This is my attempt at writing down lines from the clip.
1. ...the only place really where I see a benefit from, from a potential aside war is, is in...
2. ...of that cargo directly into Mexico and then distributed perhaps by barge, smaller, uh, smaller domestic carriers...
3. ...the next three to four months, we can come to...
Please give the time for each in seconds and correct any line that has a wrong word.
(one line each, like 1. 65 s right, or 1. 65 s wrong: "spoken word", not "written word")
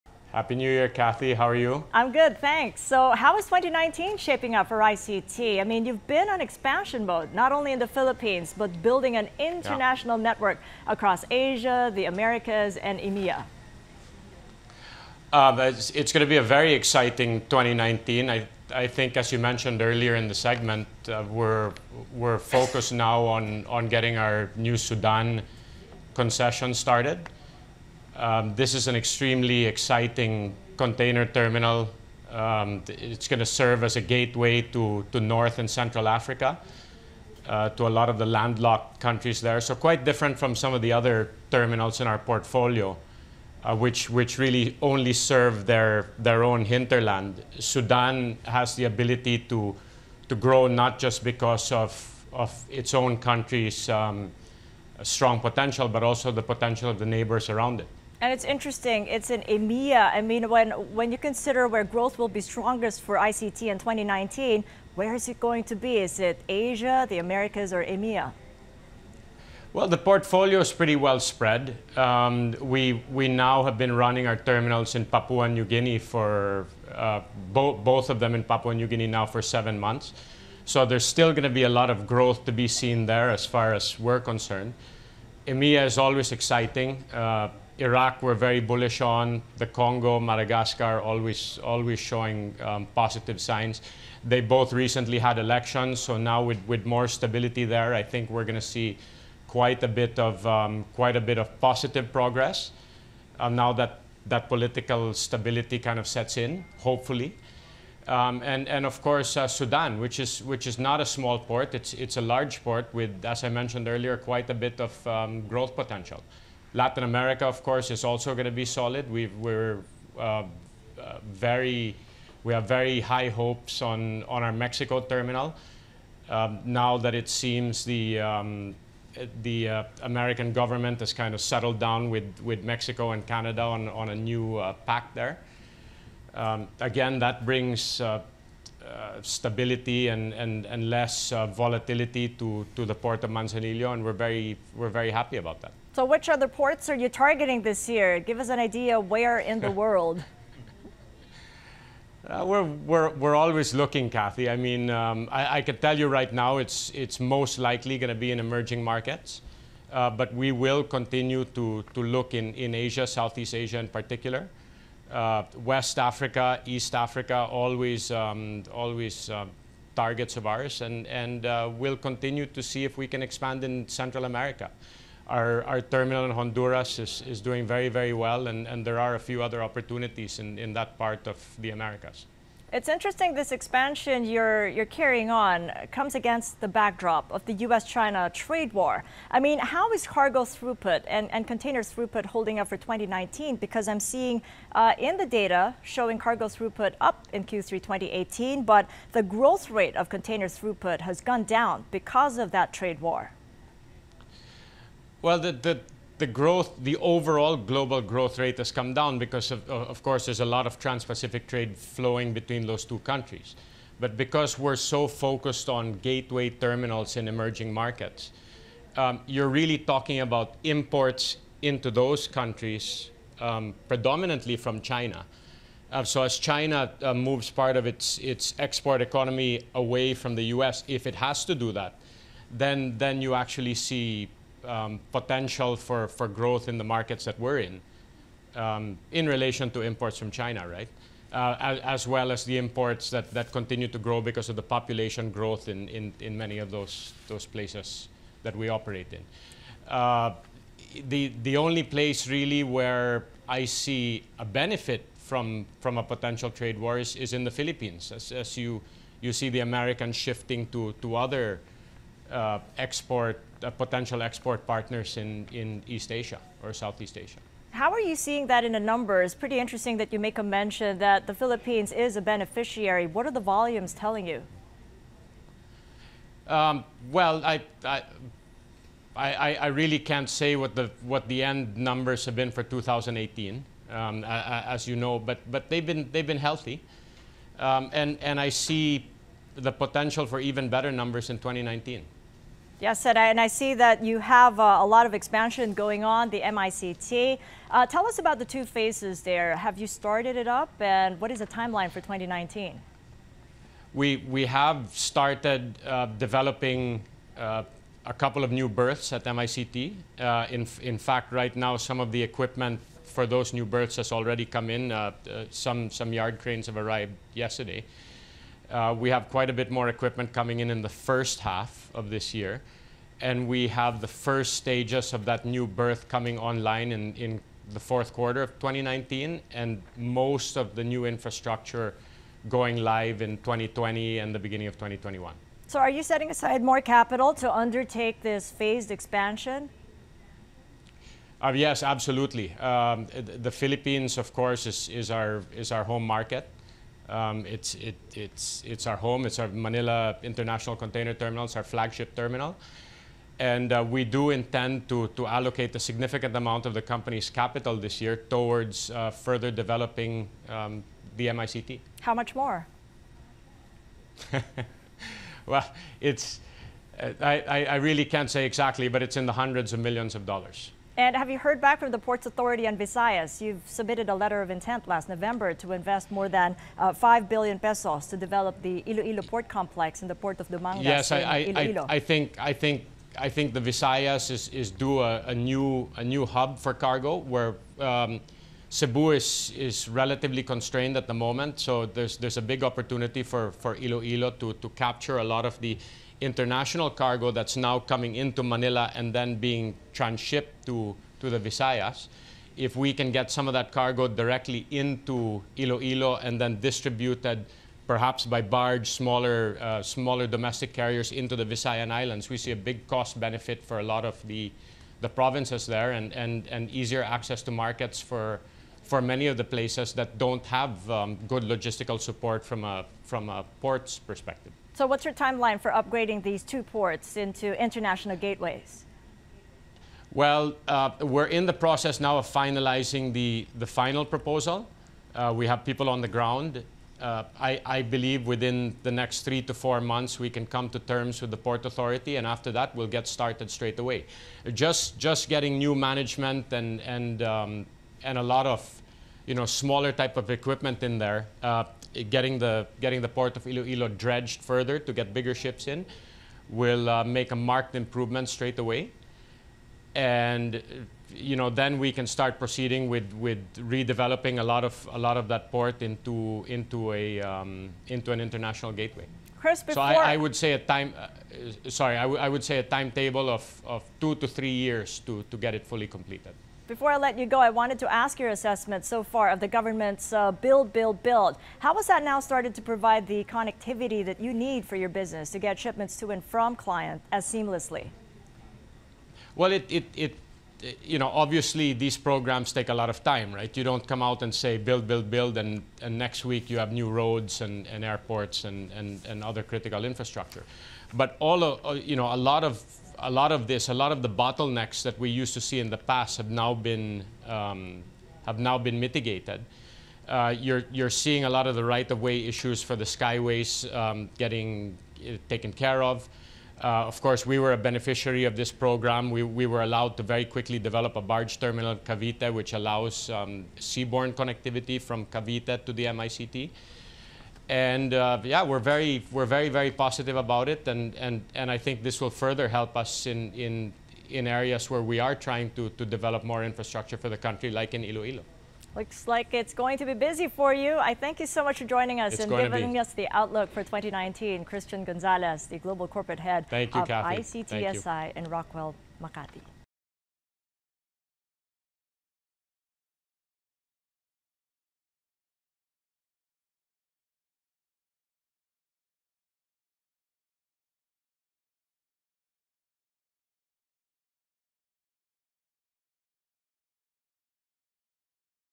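1. 251 s wrong: "trade", not "aside"
2. 403 s wrong: "Iloilo", not "Mexico"
3. 438 s right.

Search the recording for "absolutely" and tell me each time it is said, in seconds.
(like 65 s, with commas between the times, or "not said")
341 s.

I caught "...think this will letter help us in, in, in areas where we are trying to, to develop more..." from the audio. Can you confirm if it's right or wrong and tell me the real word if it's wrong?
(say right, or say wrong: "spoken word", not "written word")
wrong: "further", not "letter".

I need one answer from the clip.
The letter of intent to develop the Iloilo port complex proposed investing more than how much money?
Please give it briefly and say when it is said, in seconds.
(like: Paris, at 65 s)
5 billion pesos, at 376 s.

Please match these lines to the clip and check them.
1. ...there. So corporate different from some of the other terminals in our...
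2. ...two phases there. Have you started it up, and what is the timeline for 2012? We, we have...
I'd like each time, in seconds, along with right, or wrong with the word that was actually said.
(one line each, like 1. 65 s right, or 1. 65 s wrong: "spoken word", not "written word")
1. 39 s wrong: "quite", not "corporate"
2. 298 s wrong: "2019", not "2012".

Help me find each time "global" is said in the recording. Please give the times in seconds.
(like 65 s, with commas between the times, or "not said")
207 s, 545 s.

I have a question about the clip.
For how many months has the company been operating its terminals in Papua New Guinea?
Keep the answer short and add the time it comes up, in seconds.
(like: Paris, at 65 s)
7 months, at 79 s.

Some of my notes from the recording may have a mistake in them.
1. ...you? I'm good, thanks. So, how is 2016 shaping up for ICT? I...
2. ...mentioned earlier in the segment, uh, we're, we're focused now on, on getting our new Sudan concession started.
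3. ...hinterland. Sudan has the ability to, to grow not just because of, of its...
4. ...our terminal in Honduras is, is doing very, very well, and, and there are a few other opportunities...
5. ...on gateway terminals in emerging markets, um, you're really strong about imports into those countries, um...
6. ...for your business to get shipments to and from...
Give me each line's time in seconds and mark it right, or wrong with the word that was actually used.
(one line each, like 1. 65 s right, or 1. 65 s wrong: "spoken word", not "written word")
1. 1 s wrong: "2019", not "2016"
2. 19 s right
3. 46 s right
4. 175 s right
5. 215 s wrong: "talking", not "strong"
6. 484 s right.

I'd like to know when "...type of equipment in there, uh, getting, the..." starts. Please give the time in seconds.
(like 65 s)
449 s.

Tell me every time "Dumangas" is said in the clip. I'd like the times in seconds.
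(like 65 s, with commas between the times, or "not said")
380 s.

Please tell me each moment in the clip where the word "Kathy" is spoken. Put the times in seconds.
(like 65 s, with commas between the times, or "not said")
0 s, 154 s, 546 s.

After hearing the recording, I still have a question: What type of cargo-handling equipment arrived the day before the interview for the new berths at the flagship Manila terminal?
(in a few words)
yard cranes.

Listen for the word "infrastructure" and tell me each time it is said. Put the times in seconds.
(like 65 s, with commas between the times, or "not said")
331 s, 499 s, 536 s.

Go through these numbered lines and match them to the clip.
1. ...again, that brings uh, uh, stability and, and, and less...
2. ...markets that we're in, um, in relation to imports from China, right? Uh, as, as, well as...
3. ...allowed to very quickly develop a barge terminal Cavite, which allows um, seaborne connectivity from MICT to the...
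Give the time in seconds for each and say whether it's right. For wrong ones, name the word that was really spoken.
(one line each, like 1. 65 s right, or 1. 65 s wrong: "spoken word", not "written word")
1. 136 s right
2. 236 s right
3. 519 s wrong: "Cavite", not "MICT".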